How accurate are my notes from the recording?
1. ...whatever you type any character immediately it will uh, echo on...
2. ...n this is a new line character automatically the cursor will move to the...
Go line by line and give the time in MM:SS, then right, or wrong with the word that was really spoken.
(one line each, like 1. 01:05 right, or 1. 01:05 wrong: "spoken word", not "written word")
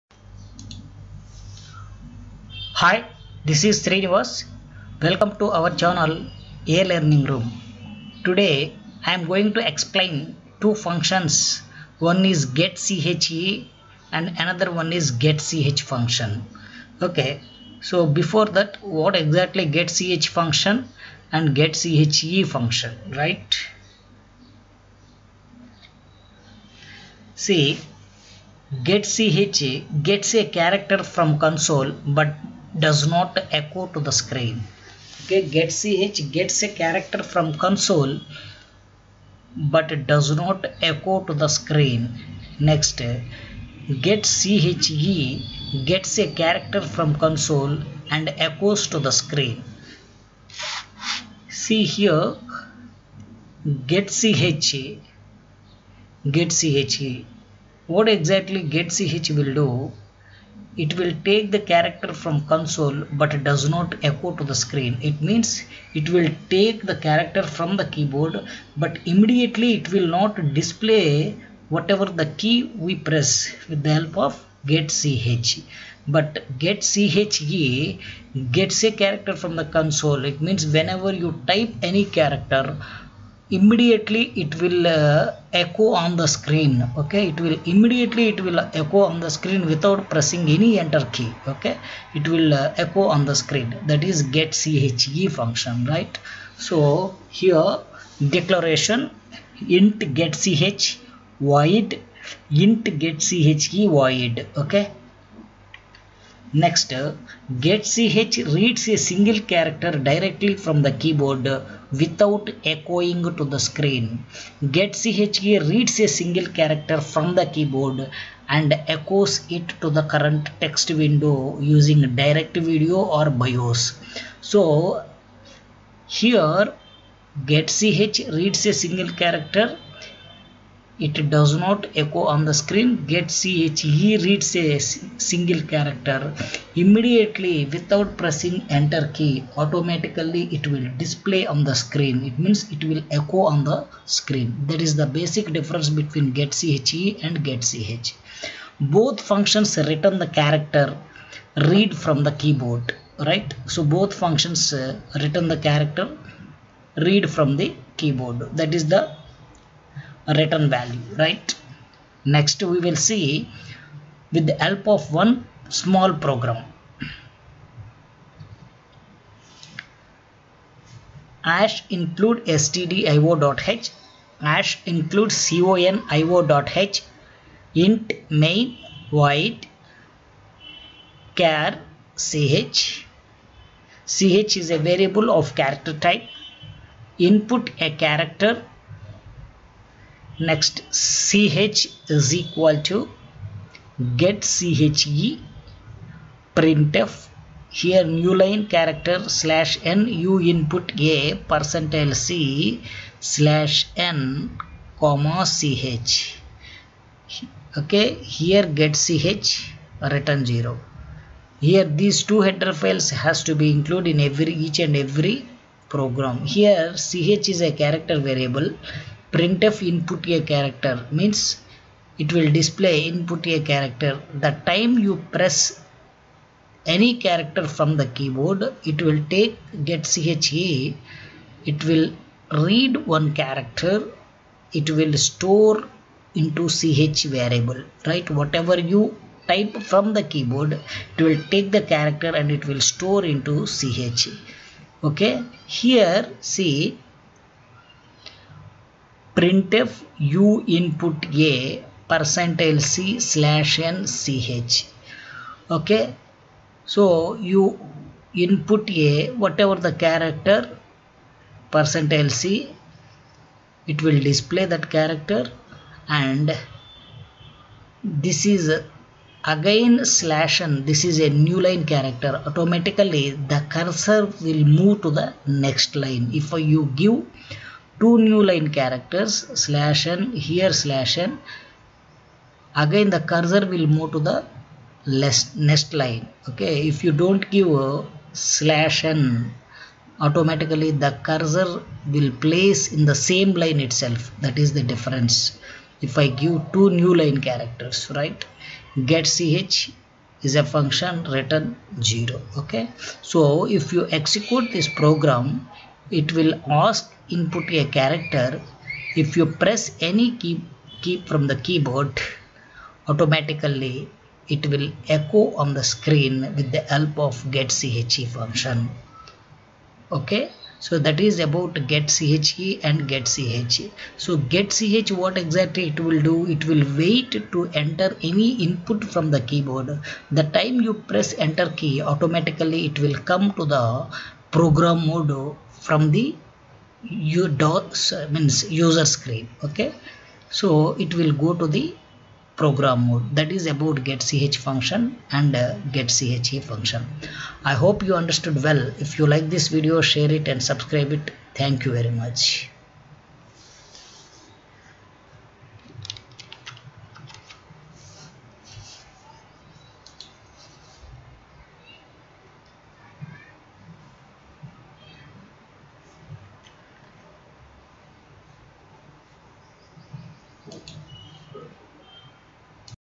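1. 01:20 wrong: "whenever", not "whatever"
2. 04:30 right.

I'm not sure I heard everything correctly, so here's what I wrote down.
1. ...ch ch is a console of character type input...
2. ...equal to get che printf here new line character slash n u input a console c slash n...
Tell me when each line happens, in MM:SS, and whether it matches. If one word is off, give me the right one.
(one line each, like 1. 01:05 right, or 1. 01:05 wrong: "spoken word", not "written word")
1. 03:02 wrong: "variable", not "console"
2. 03:12 wrong: "percentile", not "console".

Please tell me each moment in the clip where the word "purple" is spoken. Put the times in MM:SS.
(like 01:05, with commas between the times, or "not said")
not said.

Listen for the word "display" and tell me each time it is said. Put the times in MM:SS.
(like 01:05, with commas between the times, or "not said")
01:10, 02:20, 03:42, 04:24.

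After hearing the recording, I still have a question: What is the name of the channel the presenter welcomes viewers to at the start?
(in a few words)
A Learning Room.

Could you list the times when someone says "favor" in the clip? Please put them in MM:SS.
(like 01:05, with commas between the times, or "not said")
not said.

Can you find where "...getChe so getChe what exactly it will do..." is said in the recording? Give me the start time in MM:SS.
05:23.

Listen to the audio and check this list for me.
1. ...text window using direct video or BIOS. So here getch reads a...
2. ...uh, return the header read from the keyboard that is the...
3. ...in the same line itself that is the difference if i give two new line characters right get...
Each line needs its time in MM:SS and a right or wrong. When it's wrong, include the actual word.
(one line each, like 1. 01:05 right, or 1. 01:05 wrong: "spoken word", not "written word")
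1. 02:00 right
2. 02:34 wrong: "character", not "header"
3. 04:52 right.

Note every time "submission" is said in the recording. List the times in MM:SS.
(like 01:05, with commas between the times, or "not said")
not said.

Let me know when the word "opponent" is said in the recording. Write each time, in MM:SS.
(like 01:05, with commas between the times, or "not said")
not said.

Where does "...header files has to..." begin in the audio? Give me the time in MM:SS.
03:32.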